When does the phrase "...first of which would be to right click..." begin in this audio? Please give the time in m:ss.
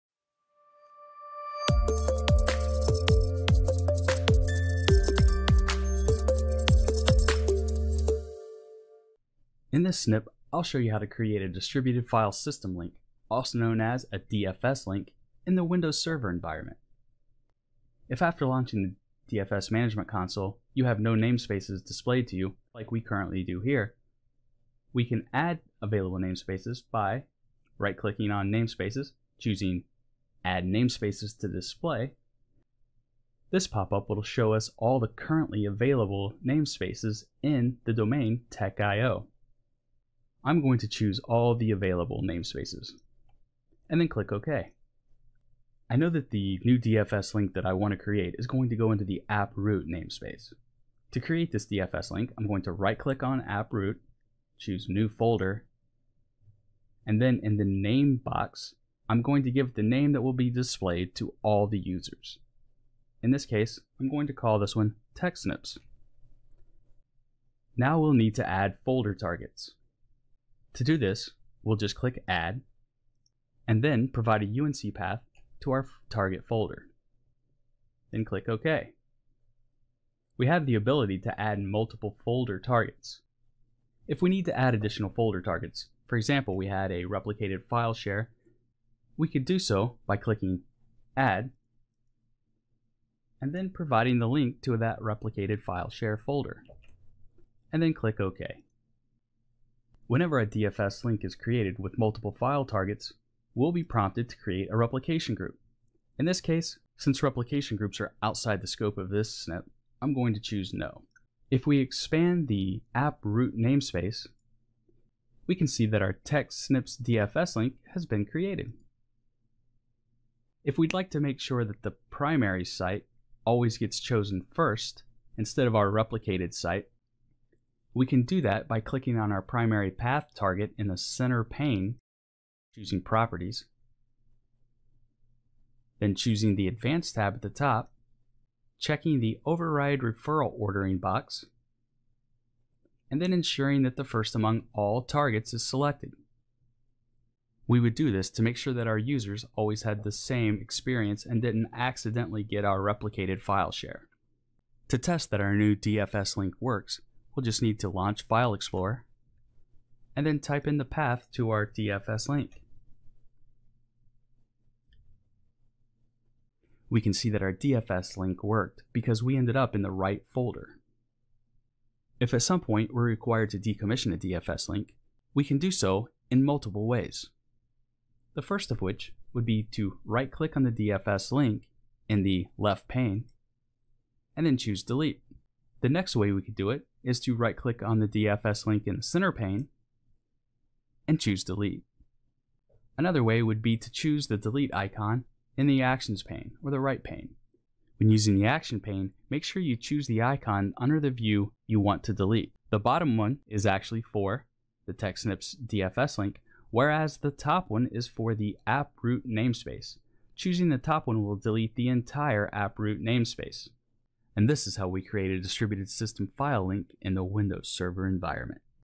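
2:58.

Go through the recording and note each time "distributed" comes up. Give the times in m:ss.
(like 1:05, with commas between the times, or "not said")
0:11, 3:35.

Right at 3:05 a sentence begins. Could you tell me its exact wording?
The next way we could do it is to right click on the DFS link in the center pane and choose delete.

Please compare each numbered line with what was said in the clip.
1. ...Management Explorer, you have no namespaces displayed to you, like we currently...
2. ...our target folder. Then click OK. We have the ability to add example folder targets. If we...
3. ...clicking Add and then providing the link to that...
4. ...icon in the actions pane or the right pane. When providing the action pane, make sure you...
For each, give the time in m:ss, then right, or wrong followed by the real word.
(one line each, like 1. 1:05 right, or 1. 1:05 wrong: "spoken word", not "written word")
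1. 0:19 wrong: "Console", not "Explorer"
2. 1:15 wrong: "multiple", not "example"
3. 1:30 right
4. 3:14 wrong: "using", not "providing".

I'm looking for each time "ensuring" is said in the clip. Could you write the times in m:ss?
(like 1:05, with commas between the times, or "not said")
2:23.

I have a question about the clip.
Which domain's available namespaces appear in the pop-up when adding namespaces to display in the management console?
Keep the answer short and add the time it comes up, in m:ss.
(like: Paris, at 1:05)
tech.io, at 0:38.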